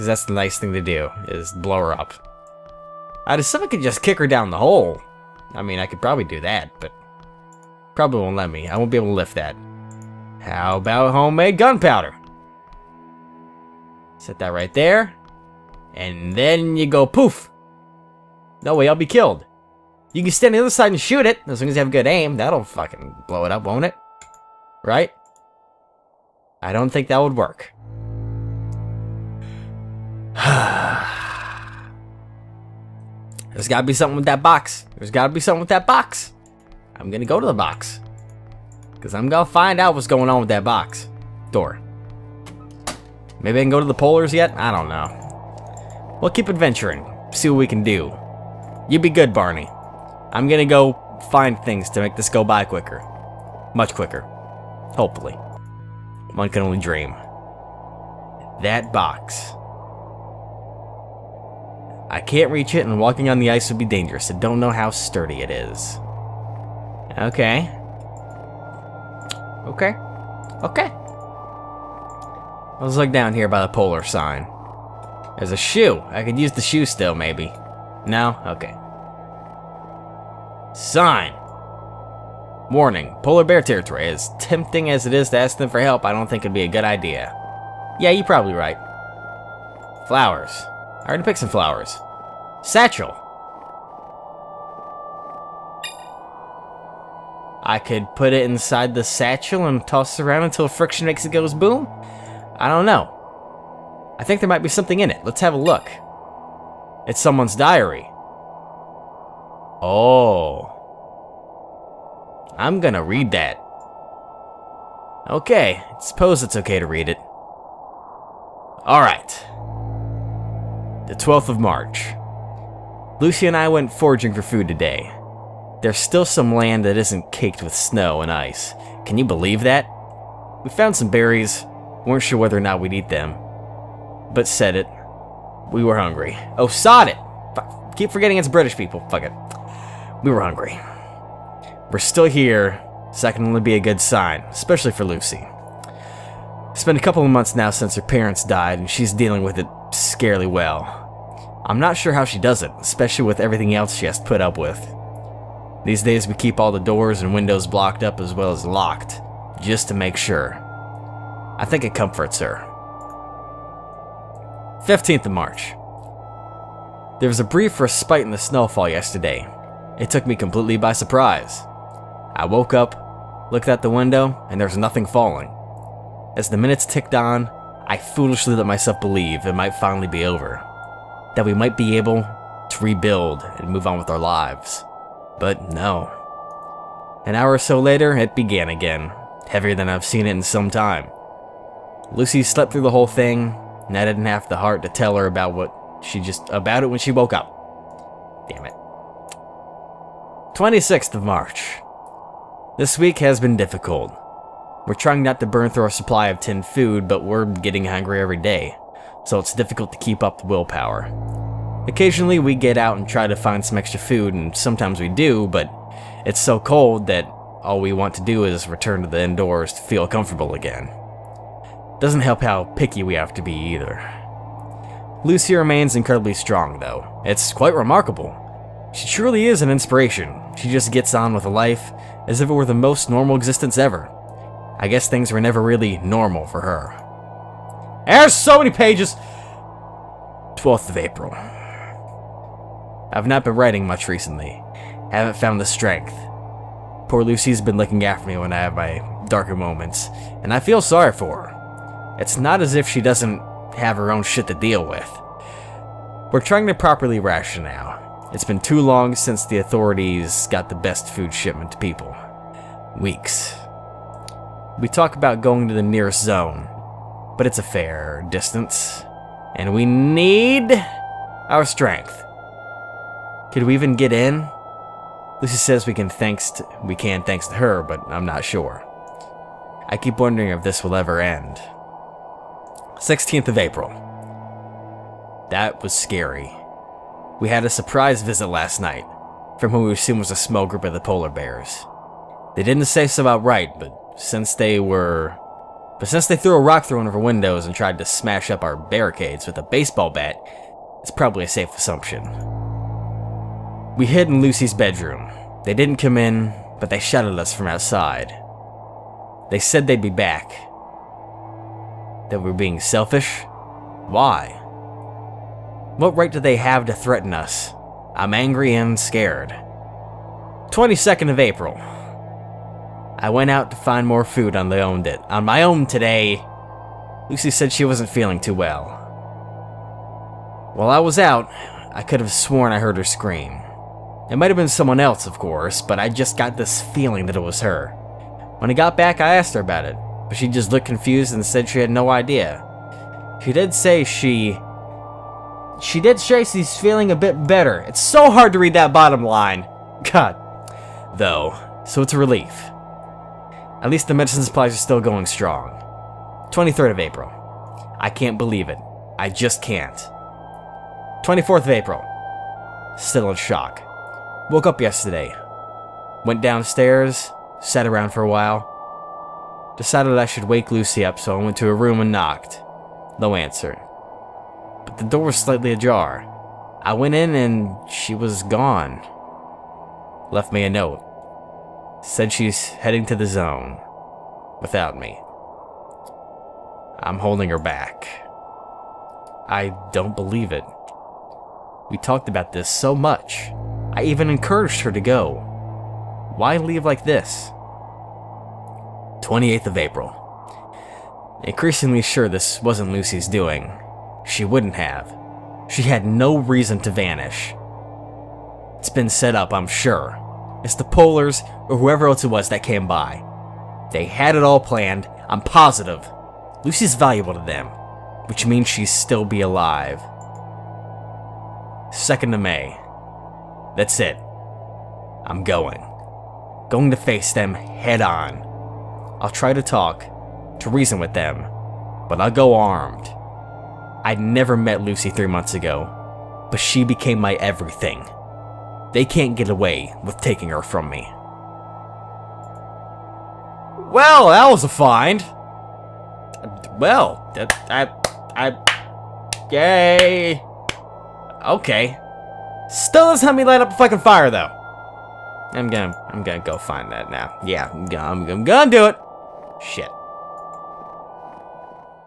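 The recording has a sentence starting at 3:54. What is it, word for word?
I guess things were never really normal for her.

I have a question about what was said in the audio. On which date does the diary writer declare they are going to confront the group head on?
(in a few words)
2nd of May.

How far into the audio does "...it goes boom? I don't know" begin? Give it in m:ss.
1:41.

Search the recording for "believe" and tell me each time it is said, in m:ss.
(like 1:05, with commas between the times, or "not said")
2:09, 2:58, 5:58, 6:30.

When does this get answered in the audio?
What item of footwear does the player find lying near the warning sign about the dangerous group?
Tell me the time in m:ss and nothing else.
1:15.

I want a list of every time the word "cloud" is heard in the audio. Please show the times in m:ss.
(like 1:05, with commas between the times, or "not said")
not said.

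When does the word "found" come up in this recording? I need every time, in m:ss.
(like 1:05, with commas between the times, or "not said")
2:10, 4:05.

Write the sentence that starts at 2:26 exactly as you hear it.
It's been a couple of months now since her parents died, and she's dealing with it scarily well.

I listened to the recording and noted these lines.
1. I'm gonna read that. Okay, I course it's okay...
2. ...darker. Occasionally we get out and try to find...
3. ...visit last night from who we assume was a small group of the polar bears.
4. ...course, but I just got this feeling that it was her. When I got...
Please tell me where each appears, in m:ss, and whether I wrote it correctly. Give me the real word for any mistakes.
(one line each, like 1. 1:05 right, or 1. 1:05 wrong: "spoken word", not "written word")
1. 1:52 wrong: "suppose", not "course"
2. 3:30 wrong: "willpower", not "darker"
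3. 4:48 right
4. 5:35 right.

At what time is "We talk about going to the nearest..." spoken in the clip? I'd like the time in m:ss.
4:24.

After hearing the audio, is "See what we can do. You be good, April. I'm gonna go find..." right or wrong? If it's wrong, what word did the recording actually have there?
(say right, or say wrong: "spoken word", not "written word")
wrong: "Barney", not "April".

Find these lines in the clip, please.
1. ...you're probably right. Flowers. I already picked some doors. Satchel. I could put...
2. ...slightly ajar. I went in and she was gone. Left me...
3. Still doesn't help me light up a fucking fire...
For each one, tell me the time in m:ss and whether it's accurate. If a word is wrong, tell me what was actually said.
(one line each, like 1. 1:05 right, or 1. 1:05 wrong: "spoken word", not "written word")
1. 1:28 wrong: "flowers", not "doors"
2. 6:15 right
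3. 7:32 right.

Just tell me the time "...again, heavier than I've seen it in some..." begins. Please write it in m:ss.
3:08.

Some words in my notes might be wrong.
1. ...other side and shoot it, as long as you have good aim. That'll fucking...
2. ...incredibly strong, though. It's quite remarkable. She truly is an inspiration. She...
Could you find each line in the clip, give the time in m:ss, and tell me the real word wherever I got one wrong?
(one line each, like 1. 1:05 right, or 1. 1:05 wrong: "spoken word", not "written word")
1. 0:20 right
2. 3:45 right.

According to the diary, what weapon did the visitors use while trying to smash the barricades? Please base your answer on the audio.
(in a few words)
A baseball bat.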